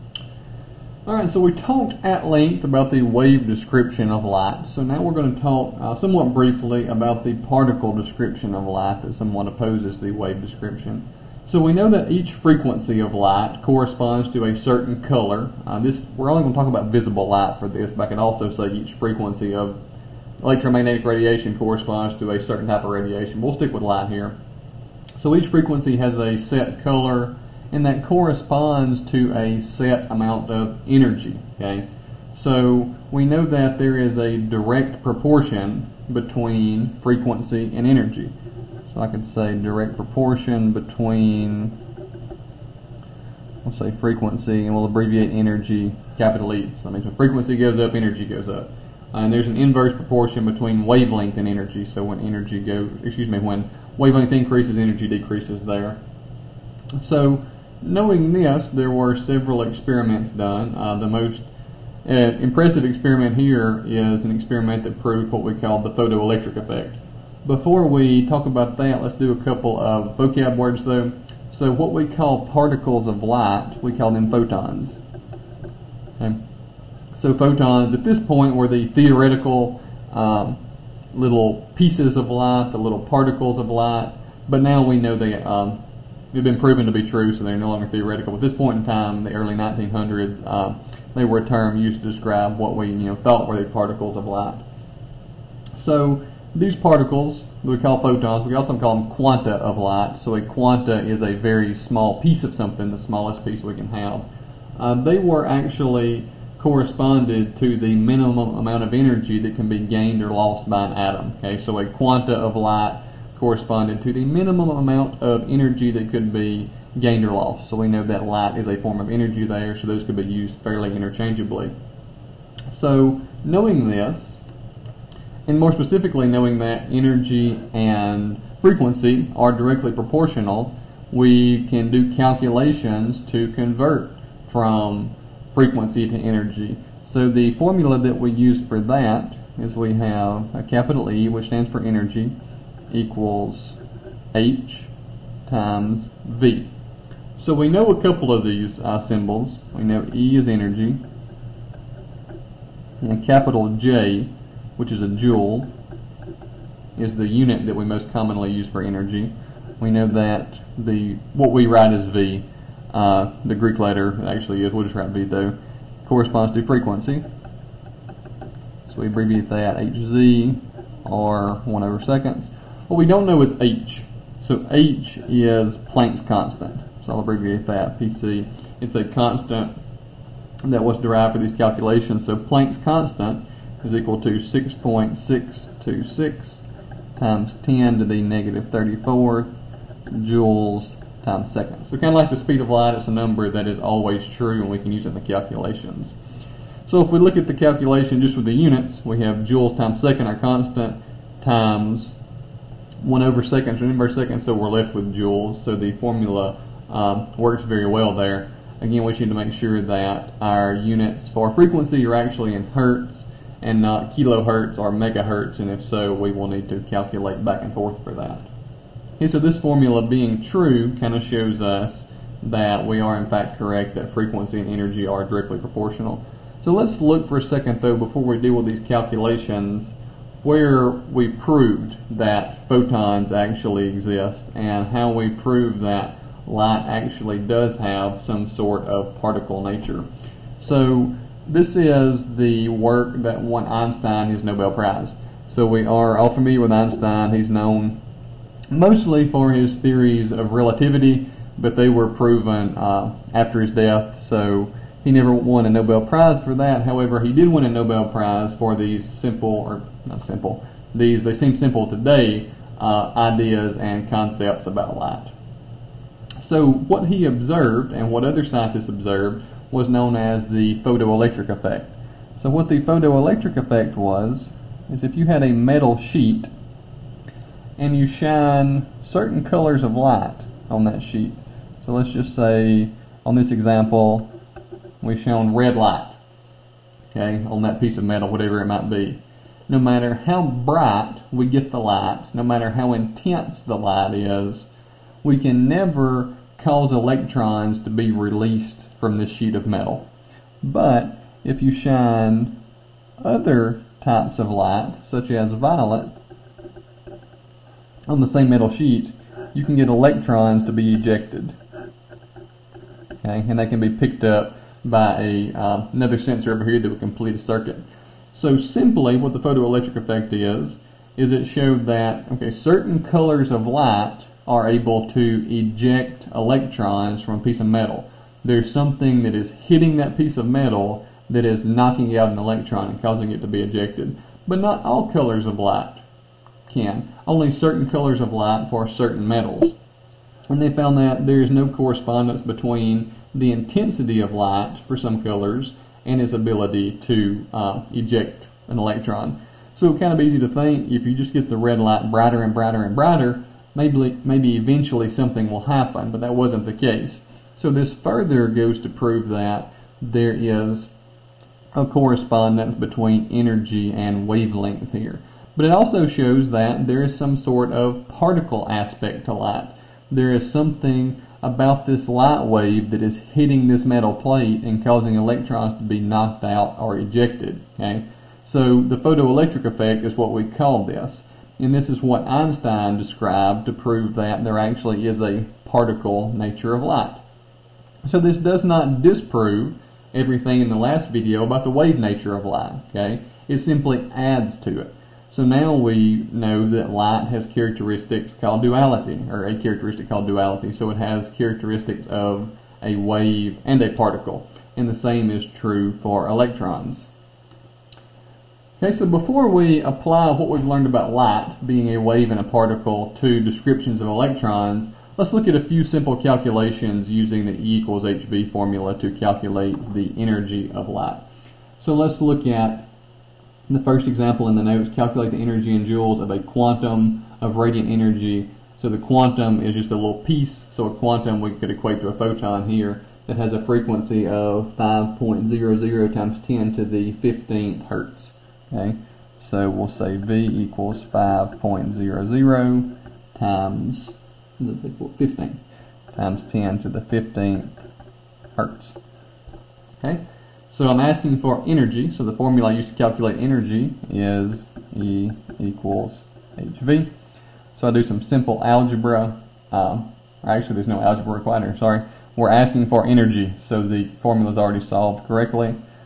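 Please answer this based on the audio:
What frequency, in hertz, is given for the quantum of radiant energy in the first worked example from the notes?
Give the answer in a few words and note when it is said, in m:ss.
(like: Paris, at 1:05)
5.00 x 10^15 Hz, at 7:14.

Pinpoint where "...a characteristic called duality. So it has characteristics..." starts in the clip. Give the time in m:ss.
6:39.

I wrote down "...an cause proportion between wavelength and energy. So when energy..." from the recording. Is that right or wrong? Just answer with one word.
wrong.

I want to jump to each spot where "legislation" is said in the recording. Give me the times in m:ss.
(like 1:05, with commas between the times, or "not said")
not said.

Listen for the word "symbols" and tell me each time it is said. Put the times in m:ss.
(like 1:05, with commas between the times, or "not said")
2:28.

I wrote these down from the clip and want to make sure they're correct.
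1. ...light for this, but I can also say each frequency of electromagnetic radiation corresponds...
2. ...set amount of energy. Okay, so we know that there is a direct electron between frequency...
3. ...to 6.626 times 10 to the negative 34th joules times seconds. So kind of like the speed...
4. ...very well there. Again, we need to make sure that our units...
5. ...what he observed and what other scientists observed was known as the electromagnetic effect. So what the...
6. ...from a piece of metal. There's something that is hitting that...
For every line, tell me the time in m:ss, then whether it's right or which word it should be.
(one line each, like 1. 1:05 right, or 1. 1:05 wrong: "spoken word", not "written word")
1. 0:17 right
2. 0:29 wrong: "proportion", not "electron"
3. 3:04 right
4. 3:27 right
5. 4:26 wrong: "photoelectric", not "electromagnetic"
6. 5:27 right.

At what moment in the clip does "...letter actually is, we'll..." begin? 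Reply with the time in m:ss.
2:43.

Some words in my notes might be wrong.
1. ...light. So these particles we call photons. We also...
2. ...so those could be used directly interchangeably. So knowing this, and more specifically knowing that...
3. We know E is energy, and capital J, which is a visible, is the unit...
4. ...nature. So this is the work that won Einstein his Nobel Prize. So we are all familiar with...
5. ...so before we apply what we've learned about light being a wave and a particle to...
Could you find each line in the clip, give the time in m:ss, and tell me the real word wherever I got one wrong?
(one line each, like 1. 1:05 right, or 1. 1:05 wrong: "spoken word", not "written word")
1. 1:34 right
2. 1:59 wrong: "fairly", not "directly"
3. 2:29 wrong: "joule", not "visible"
4. 3:59 right
5. 6:48 right.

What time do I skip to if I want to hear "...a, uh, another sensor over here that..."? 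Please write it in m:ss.
5:15.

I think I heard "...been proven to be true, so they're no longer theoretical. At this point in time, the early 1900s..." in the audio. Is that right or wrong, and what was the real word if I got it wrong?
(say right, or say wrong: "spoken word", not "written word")
right.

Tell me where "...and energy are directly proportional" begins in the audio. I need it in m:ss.
3:44.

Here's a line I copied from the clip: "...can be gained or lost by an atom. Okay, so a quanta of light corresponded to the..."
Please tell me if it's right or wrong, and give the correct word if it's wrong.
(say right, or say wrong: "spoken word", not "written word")
right.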